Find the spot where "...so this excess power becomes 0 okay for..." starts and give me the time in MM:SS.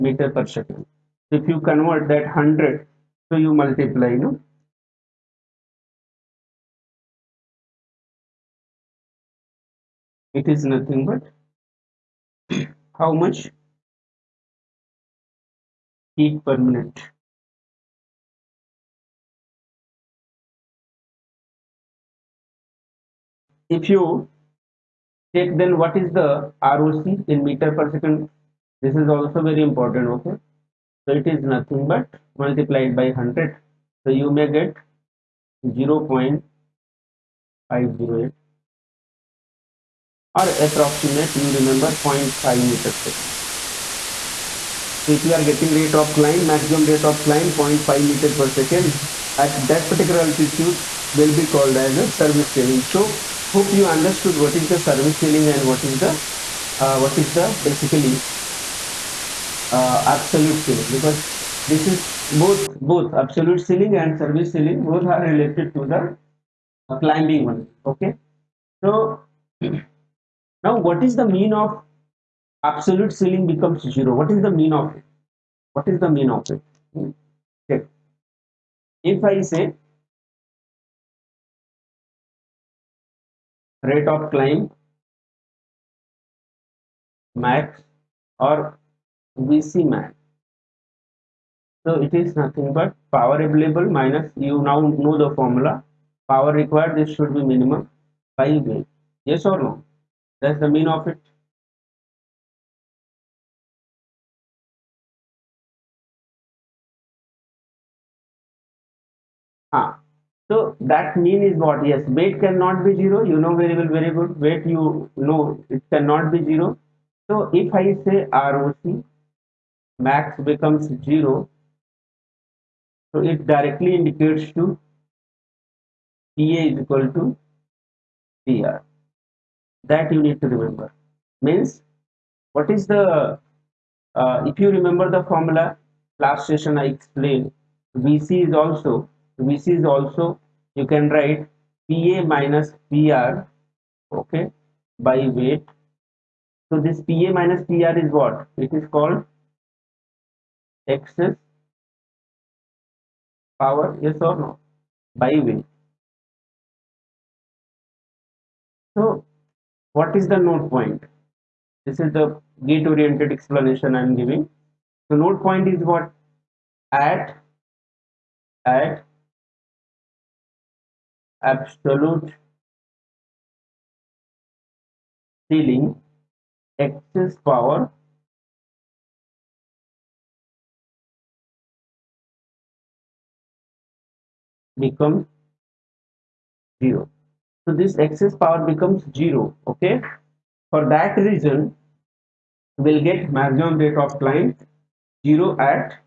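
03:07.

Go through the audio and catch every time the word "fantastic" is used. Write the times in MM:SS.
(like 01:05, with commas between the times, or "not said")
not said.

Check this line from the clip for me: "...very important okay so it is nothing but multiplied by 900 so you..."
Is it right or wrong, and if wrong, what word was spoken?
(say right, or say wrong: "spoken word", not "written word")
wrong: "100", not "900".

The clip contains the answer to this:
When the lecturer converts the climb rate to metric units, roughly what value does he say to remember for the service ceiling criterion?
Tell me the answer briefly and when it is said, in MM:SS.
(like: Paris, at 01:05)
0.5 meter per second, at 00:42.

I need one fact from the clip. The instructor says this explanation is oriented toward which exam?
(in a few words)
GATE.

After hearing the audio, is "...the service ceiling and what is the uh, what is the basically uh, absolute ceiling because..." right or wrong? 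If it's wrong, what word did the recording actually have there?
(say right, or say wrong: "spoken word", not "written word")
right.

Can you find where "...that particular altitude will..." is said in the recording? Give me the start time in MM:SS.
00:49.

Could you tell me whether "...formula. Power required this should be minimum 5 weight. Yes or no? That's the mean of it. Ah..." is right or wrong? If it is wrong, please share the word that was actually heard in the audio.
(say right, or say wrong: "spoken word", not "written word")
right.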